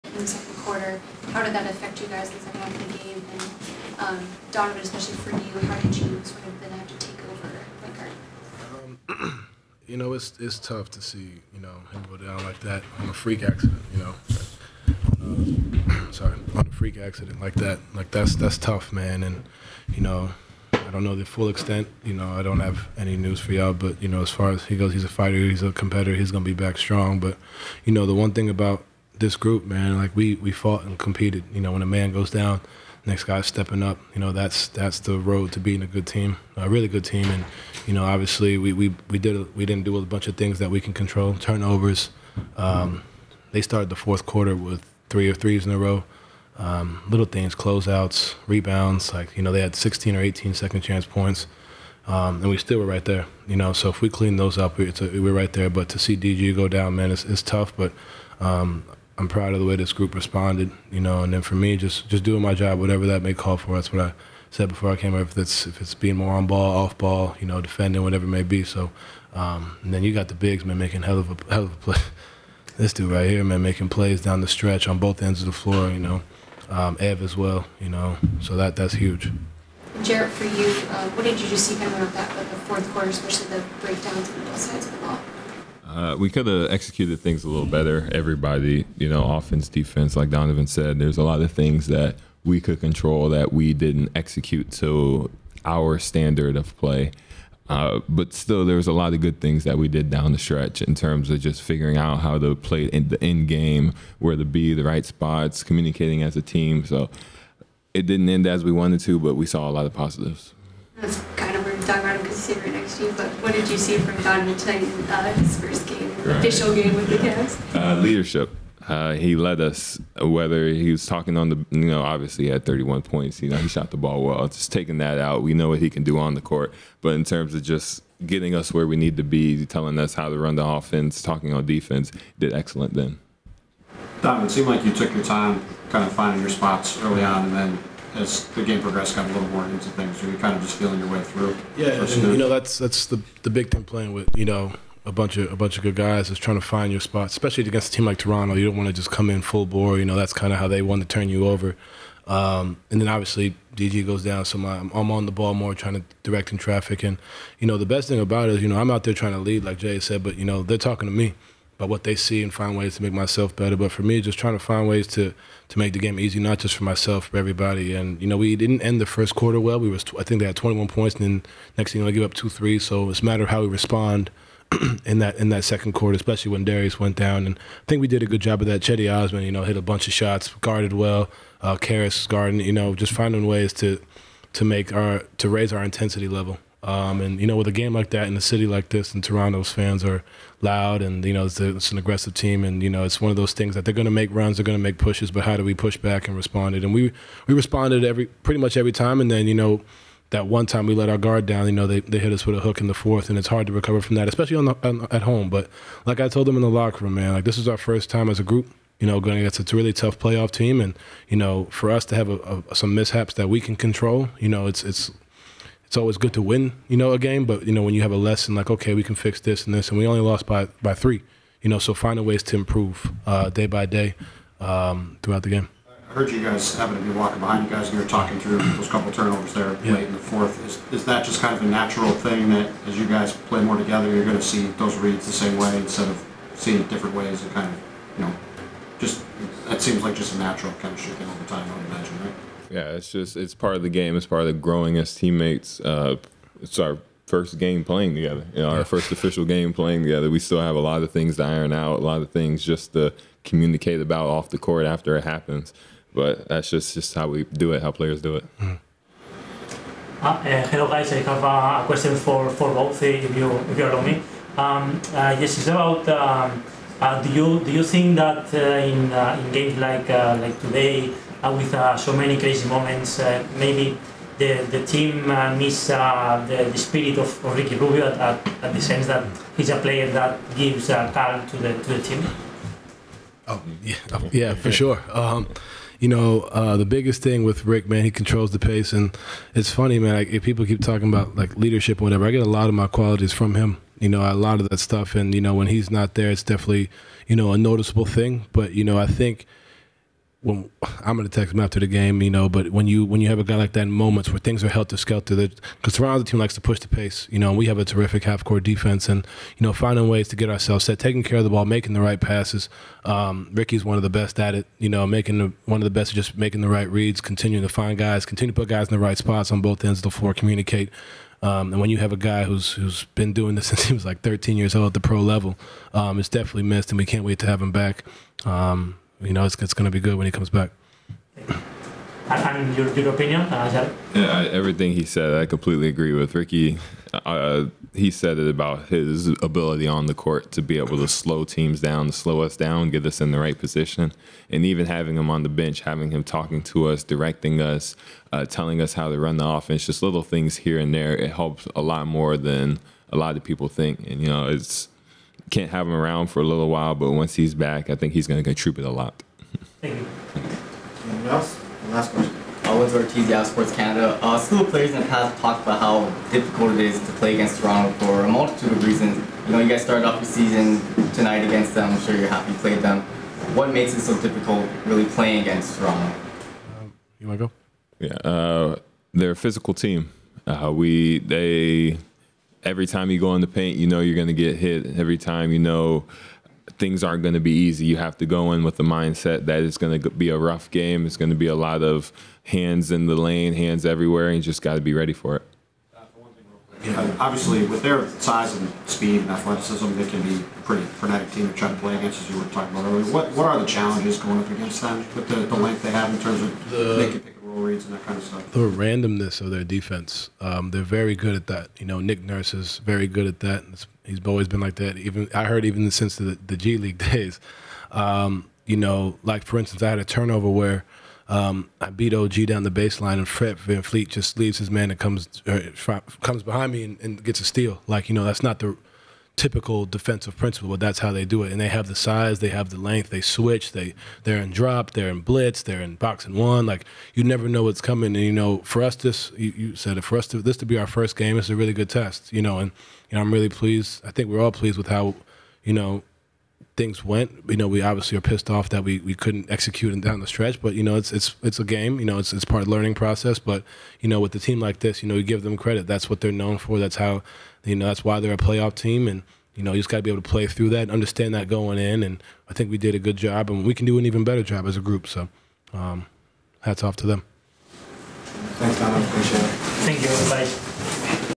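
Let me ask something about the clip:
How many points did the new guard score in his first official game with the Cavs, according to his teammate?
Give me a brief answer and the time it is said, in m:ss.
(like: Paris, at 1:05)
31, at 2:02.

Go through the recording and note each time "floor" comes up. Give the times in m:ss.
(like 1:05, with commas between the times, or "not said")
1:15, 5:20.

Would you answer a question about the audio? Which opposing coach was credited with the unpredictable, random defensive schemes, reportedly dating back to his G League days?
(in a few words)
Nick Nurse.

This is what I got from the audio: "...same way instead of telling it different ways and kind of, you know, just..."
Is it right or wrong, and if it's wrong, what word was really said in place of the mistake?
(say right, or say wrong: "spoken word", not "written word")
wrong: "seeing", not "telling".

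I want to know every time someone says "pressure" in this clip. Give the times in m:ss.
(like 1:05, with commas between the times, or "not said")
not said.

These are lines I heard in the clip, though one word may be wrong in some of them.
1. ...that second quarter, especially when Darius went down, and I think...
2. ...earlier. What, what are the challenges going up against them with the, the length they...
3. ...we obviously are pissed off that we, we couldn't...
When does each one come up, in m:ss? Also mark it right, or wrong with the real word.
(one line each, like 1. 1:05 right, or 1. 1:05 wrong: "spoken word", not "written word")
1. 2:55 right
2. 6:42 right
3. 7:27 right.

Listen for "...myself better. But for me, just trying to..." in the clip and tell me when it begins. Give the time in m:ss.
2:43.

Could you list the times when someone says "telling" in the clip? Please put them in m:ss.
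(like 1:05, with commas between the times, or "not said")
2:09, 5:48.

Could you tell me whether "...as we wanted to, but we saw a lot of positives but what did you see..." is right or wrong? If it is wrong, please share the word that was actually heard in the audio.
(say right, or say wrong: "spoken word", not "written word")
right.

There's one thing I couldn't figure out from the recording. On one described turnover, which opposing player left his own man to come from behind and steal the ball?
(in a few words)
Fred VanVleet.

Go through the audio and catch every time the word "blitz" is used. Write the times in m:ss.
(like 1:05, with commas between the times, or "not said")
7:15.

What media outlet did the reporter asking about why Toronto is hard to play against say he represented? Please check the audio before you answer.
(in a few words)
Sports Canada.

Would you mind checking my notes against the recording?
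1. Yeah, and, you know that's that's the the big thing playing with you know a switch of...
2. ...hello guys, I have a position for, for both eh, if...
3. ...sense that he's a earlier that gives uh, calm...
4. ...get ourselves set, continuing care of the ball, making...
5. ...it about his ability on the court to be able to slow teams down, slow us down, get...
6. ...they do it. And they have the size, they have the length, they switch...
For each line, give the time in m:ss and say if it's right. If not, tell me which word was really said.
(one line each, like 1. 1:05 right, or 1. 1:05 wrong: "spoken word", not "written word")
1. 2:21 wrong: "bunch", not "switch"
2. 4:20 wrong: "question", not "position"
3. 4:38 wrong: "player", not "earlier"
4. 5:10 wrong: "taking", not "continuing"
5. 5:38 right
6. 7:11 right.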